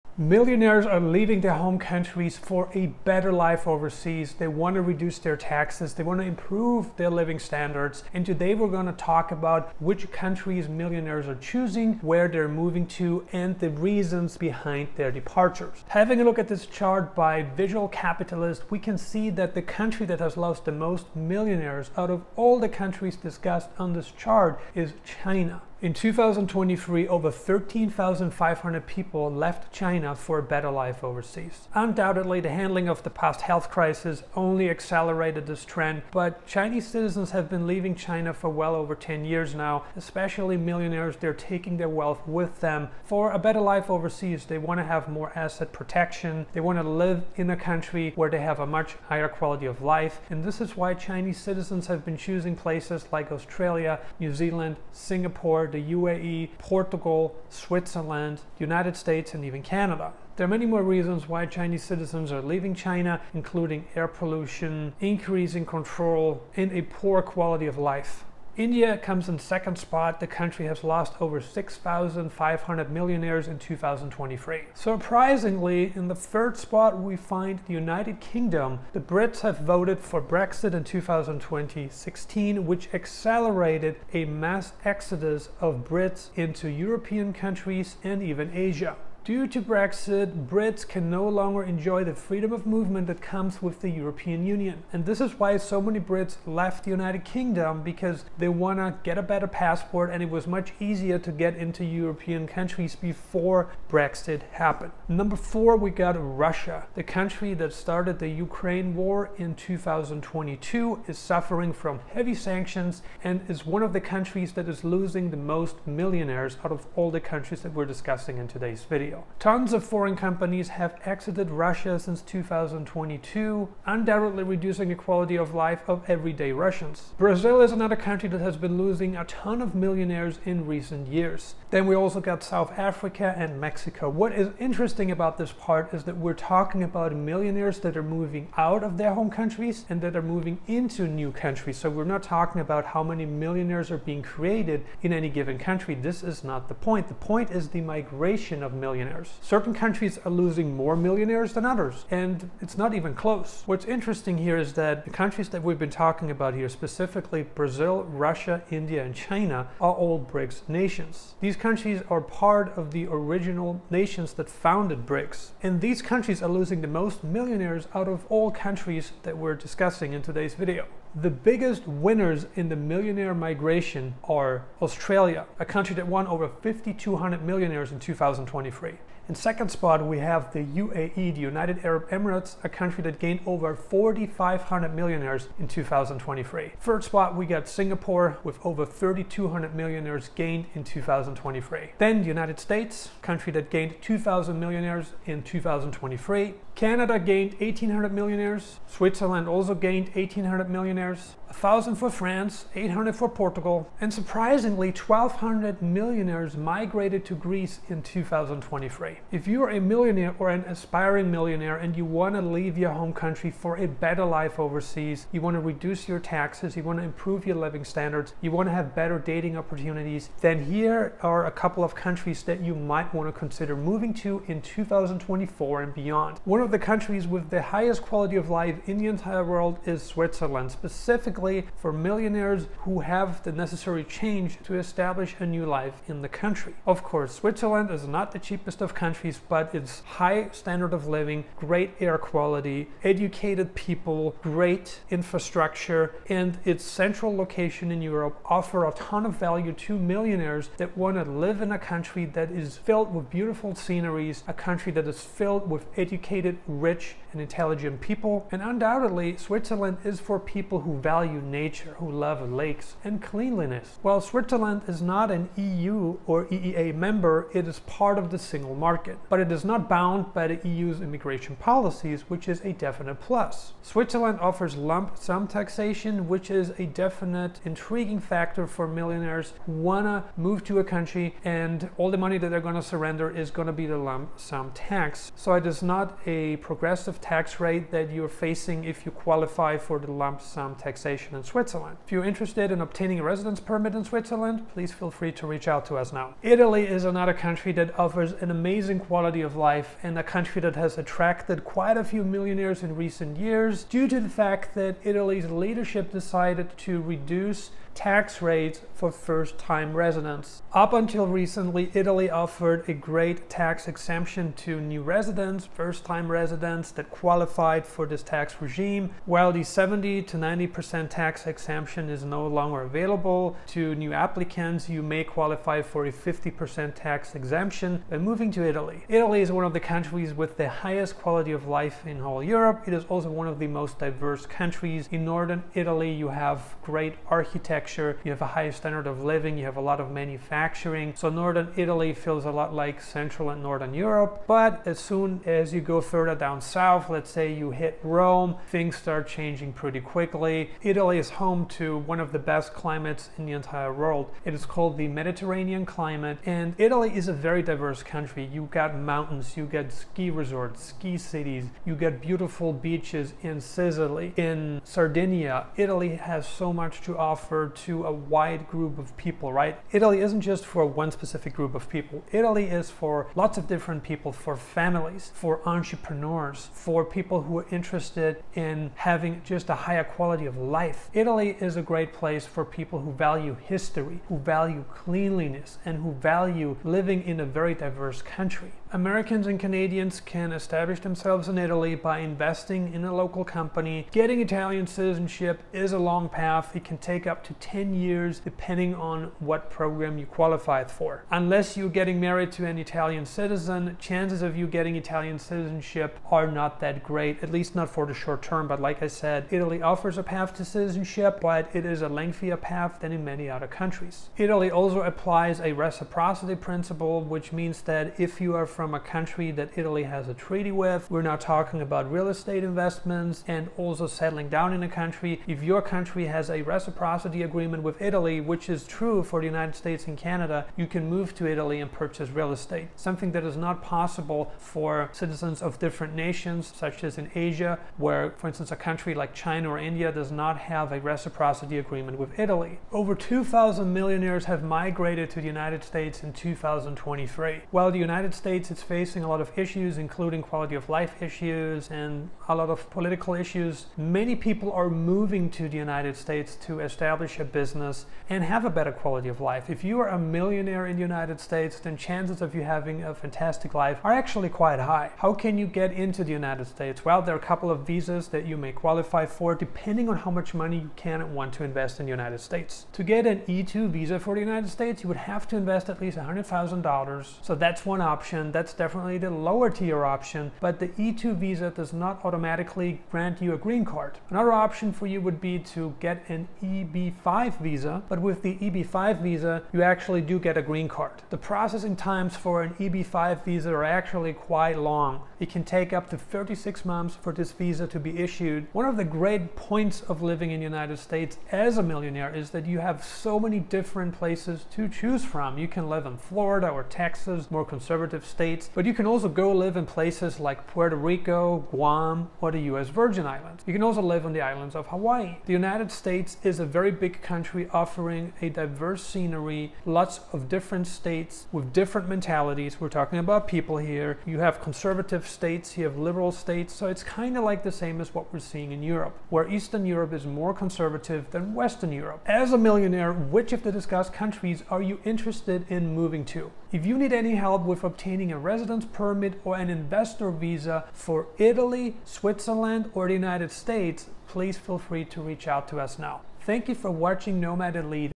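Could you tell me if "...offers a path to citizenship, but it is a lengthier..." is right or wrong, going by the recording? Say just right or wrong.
right.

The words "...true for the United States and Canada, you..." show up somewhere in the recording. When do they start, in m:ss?
7:08.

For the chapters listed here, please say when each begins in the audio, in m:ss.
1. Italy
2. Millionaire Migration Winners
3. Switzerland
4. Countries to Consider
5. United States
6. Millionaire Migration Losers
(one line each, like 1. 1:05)
1. 4:56
2. 2:50
3. 3:46
4. 3:29
5. 7:22
6. 0:15.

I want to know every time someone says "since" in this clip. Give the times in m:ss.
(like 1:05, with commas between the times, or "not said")
2:01.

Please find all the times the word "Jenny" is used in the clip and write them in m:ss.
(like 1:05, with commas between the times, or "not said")
not said.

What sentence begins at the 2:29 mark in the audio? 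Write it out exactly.
Certain countries are losing more millionaires than others, and it's not even close.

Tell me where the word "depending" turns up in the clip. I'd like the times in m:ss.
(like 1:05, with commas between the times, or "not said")
6:38, 7:49.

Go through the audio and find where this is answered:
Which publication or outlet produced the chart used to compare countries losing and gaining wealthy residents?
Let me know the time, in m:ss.
0:17.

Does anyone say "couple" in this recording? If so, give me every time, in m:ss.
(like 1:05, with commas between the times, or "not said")
3:41, 7:47.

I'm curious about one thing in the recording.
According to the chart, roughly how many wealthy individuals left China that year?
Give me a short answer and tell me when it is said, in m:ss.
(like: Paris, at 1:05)
over 13,500, at 0:27.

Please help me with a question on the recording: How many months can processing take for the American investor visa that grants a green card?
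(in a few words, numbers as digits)
36 months.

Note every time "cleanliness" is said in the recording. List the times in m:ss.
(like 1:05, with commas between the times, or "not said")
4:23, 6:24.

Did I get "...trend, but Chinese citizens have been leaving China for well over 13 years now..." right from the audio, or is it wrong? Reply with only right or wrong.
wrong.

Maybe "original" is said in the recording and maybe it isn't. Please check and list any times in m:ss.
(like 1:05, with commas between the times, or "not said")
2:43.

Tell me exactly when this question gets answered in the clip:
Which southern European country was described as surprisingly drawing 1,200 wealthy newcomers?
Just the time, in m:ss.
3:27.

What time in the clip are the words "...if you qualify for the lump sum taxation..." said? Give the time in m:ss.
4:48.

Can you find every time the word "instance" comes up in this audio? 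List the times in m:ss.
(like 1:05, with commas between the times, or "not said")
7:18.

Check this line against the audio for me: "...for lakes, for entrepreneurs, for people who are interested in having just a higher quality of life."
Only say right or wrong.
wrong.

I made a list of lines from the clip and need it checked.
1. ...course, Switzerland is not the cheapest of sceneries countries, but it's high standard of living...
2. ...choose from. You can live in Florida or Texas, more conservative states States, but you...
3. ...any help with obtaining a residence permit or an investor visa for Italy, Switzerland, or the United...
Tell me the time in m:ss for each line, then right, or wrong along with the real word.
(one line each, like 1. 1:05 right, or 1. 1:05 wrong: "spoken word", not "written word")
1. 3:57 wrong: "countries", not "sceneries"
2. 8:24 right
3. 8:57 right.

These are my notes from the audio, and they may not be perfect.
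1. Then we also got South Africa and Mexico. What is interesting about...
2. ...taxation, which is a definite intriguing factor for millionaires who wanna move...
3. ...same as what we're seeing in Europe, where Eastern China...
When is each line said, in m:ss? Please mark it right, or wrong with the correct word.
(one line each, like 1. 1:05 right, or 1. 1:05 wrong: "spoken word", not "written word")
1. 2:11 right
2. 4:35 right
3. 8:47 wrong: "Europe", not "China".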